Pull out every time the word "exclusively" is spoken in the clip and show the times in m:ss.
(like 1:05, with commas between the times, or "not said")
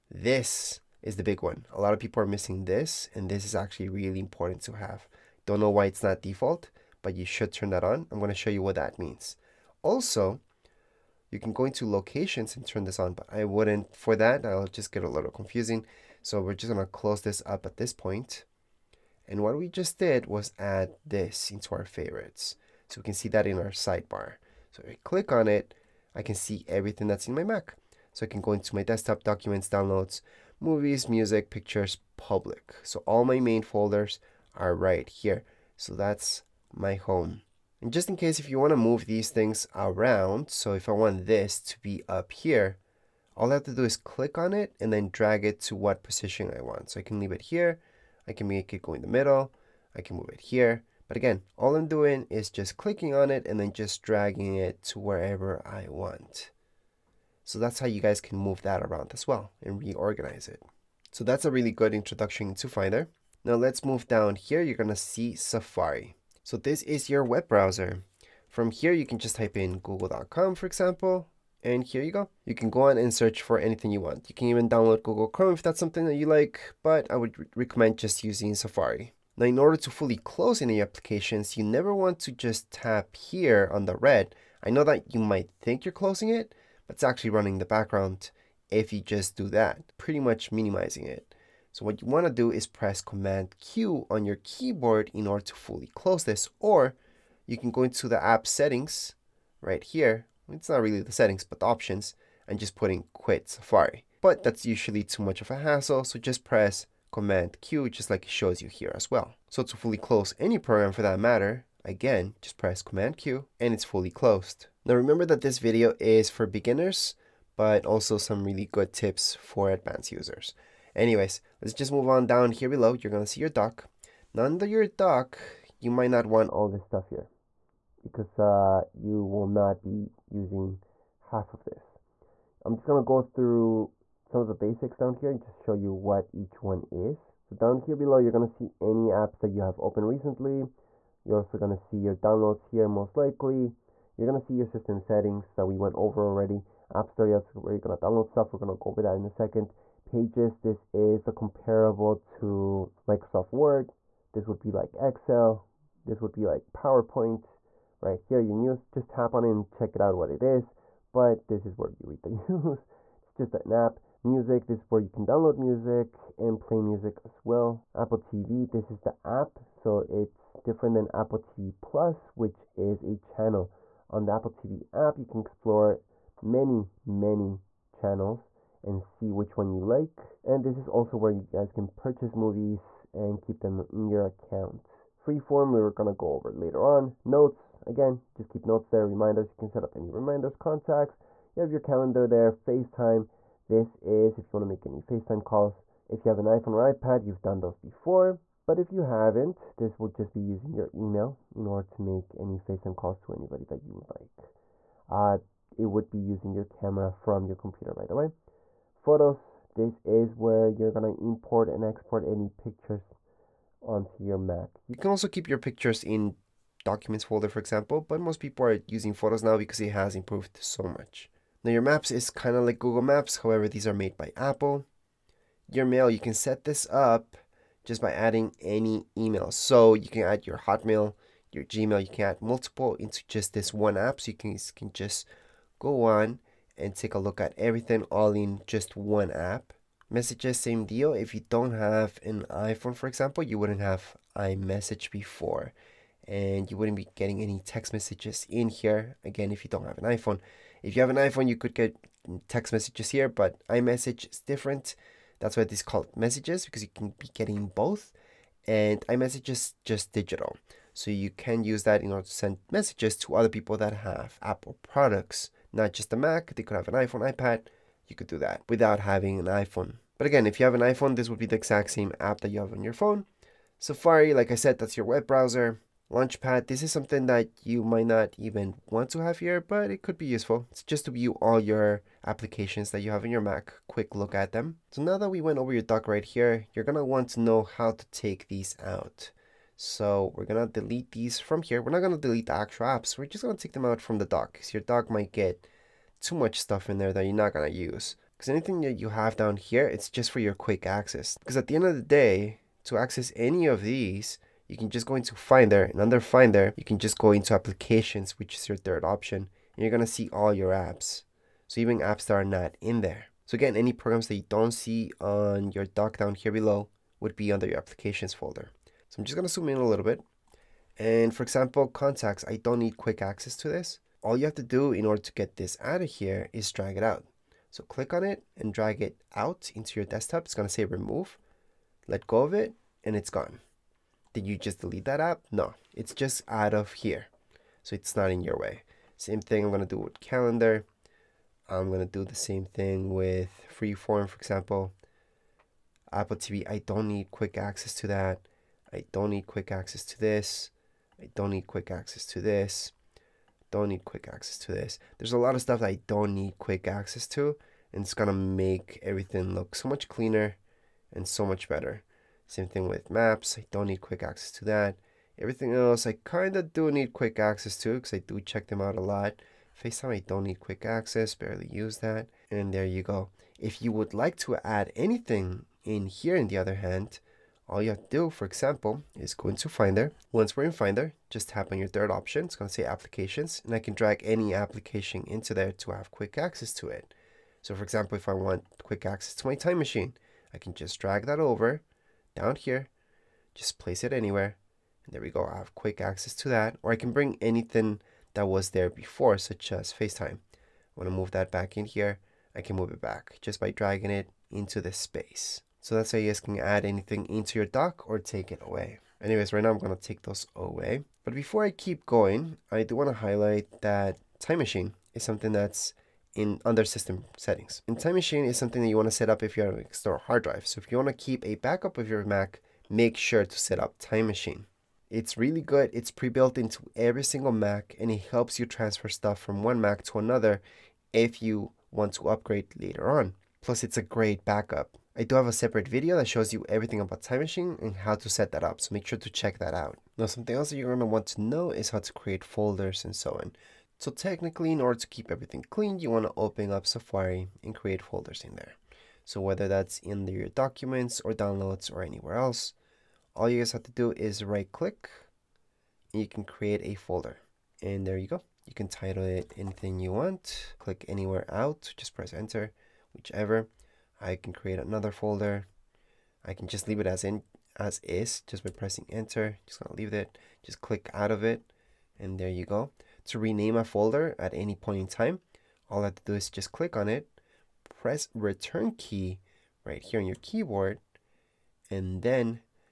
not said.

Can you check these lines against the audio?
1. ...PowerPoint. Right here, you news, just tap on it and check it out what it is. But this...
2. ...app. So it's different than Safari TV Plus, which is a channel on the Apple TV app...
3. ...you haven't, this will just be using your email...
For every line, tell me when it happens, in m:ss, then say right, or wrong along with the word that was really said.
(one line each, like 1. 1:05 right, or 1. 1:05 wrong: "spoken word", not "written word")
1. 2:36 right
2. 2:49 wrong: "Apple", not "Safari"
3. 3:18 right.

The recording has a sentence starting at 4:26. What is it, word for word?
They could have an iPhone, iPad.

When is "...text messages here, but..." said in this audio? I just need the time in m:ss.
4:12.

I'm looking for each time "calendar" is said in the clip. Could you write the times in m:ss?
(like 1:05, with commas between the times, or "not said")
3:11, 5:40.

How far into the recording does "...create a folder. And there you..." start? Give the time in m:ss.
7:36.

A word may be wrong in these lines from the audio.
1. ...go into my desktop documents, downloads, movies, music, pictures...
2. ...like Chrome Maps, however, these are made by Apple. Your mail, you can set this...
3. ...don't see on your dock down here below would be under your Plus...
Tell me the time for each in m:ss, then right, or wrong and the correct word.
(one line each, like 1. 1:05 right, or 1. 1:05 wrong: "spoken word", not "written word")
1. 0:28 right
2. 3:42 wrong: "Google", not "Chrome"
3. 5:14 wrong: "Applications", not "Plus".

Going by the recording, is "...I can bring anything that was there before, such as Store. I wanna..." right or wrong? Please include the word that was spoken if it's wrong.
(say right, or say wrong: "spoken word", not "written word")
wrong: "FaceTime", not "Store".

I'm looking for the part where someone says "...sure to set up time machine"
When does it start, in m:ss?
7:03.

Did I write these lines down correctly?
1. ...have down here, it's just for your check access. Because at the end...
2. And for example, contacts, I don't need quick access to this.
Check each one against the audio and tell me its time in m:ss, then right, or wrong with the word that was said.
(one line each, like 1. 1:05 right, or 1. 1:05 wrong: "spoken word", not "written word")
1. 4:59 wrong: "quick", not "check"
2. 5:20 right.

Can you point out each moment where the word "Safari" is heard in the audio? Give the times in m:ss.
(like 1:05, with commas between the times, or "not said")
1:05, 1:18, 1:43, 4:33, 7:26.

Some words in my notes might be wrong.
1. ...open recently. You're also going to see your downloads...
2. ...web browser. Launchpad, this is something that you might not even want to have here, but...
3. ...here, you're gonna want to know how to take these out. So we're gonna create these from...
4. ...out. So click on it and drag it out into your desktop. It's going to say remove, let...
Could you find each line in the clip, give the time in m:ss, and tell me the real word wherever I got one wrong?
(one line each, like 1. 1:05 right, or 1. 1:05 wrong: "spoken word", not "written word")
1. 2:19 right
2. 4:35 right
3. 4:46 wrong: "delete", not "create"
4. 5:27 right.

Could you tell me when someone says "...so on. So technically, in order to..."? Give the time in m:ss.
7:23.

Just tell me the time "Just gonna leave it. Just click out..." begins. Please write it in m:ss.
7:49.